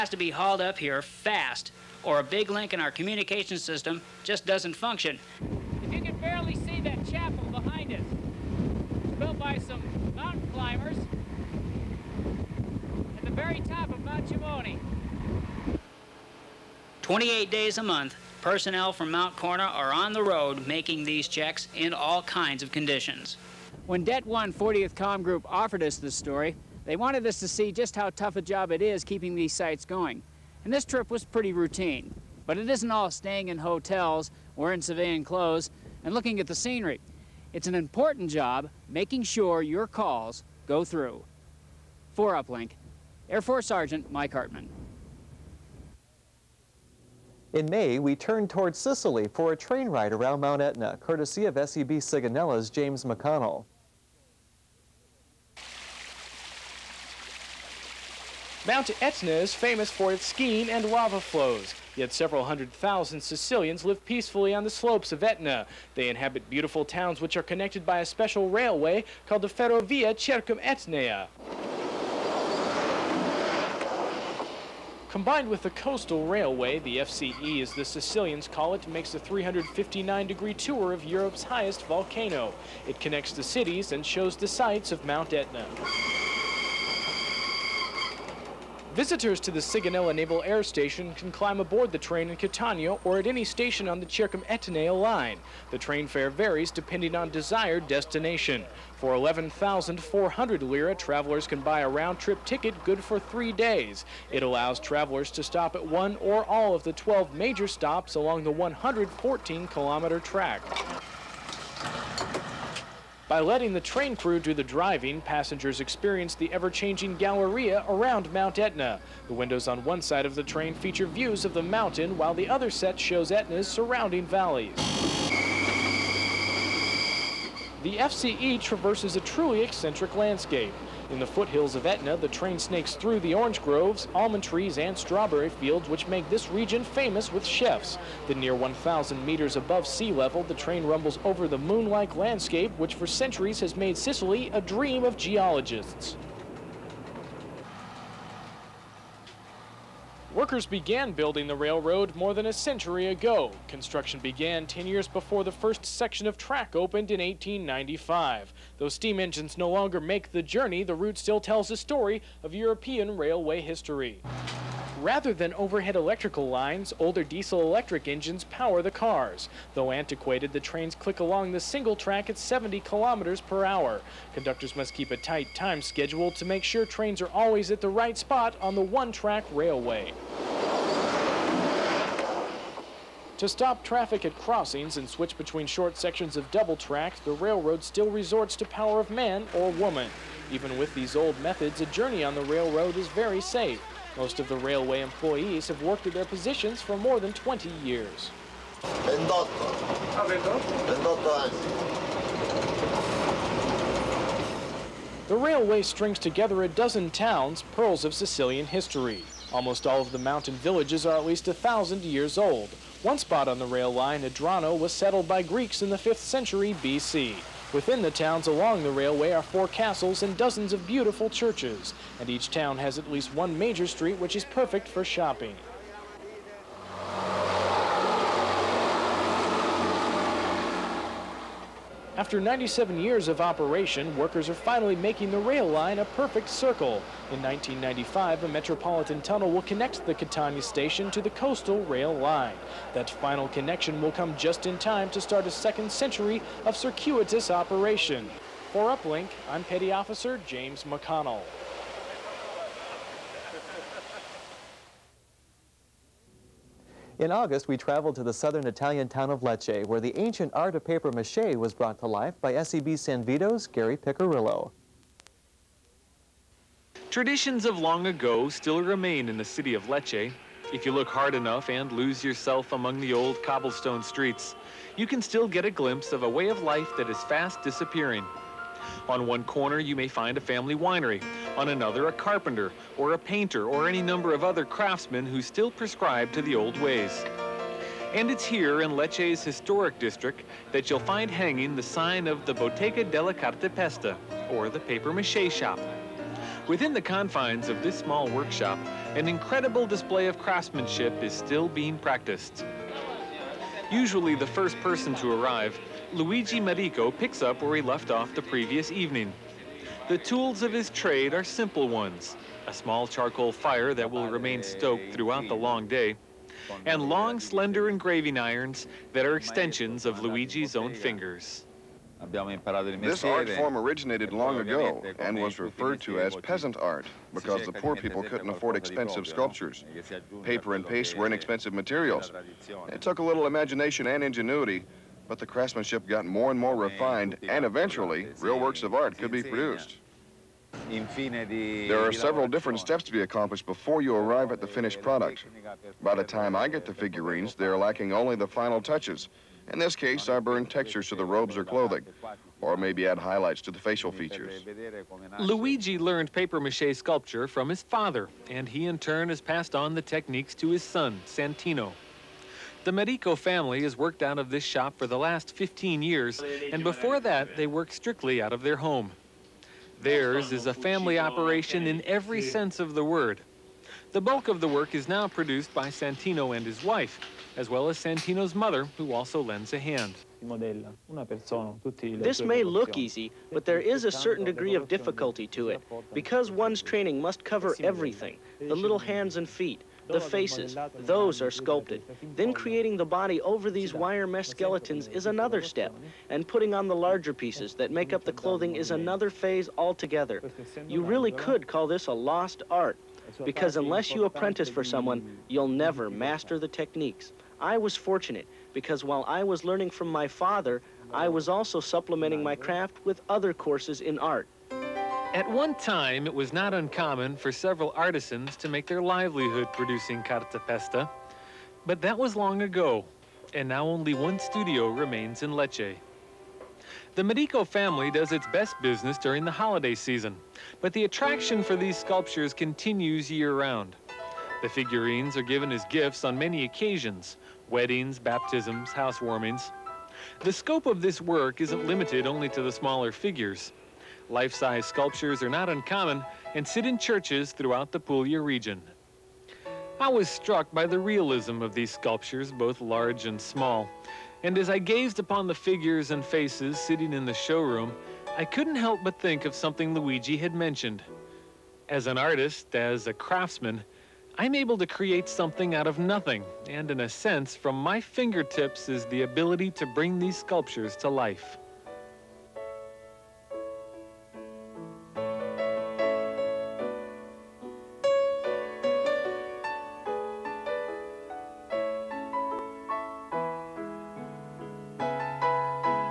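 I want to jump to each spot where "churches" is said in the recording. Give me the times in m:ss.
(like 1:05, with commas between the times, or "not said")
3:41, 7:26.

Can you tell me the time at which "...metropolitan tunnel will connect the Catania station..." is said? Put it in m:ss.
3:58.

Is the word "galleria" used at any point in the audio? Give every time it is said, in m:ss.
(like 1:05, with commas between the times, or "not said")
1:57.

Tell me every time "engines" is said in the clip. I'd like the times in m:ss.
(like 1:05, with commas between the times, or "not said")
2:39, 2:48.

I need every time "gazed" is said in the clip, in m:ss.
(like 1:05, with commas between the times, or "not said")
7:34.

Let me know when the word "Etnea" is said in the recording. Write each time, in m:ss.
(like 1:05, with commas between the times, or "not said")
1:10, 1:34.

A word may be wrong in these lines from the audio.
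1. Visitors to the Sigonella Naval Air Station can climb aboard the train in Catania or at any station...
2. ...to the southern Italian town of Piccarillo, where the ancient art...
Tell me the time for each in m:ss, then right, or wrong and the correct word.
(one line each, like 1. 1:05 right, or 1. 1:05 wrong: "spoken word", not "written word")
1. 1:28 right
2. 4:18 wrong: "Lecce", not "Piccarillo".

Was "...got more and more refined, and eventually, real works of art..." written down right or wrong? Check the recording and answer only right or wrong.
right.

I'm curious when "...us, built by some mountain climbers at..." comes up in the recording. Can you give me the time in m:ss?
0:07.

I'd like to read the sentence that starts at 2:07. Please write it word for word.
The FCE traverses a truly eccentric landscape.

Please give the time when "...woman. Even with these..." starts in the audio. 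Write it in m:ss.
3:09.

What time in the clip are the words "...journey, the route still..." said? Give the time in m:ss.
2:40.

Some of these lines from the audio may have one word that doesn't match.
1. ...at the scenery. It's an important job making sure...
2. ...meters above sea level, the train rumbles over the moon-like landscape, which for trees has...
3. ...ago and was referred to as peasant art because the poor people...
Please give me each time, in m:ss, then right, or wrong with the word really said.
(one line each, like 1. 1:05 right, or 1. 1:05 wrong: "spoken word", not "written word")
1. 0:36 right
2. 2:19 wrong: "centuries", not "trees"
3. 5:24 right.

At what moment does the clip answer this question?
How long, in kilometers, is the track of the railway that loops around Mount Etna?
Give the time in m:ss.
1:48.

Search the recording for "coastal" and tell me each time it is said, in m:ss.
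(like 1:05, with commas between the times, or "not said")
1:15, 4:01.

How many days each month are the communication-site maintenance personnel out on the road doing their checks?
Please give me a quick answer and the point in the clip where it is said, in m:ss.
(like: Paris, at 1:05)
28, at 0:17.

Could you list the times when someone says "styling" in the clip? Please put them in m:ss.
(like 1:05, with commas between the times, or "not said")
not said.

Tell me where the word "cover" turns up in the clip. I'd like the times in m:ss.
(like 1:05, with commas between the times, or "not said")
6:27.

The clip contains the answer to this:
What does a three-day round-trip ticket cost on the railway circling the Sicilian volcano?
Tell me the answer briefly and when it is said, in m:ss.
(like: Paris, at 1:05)
11,400 lira, at 1:39.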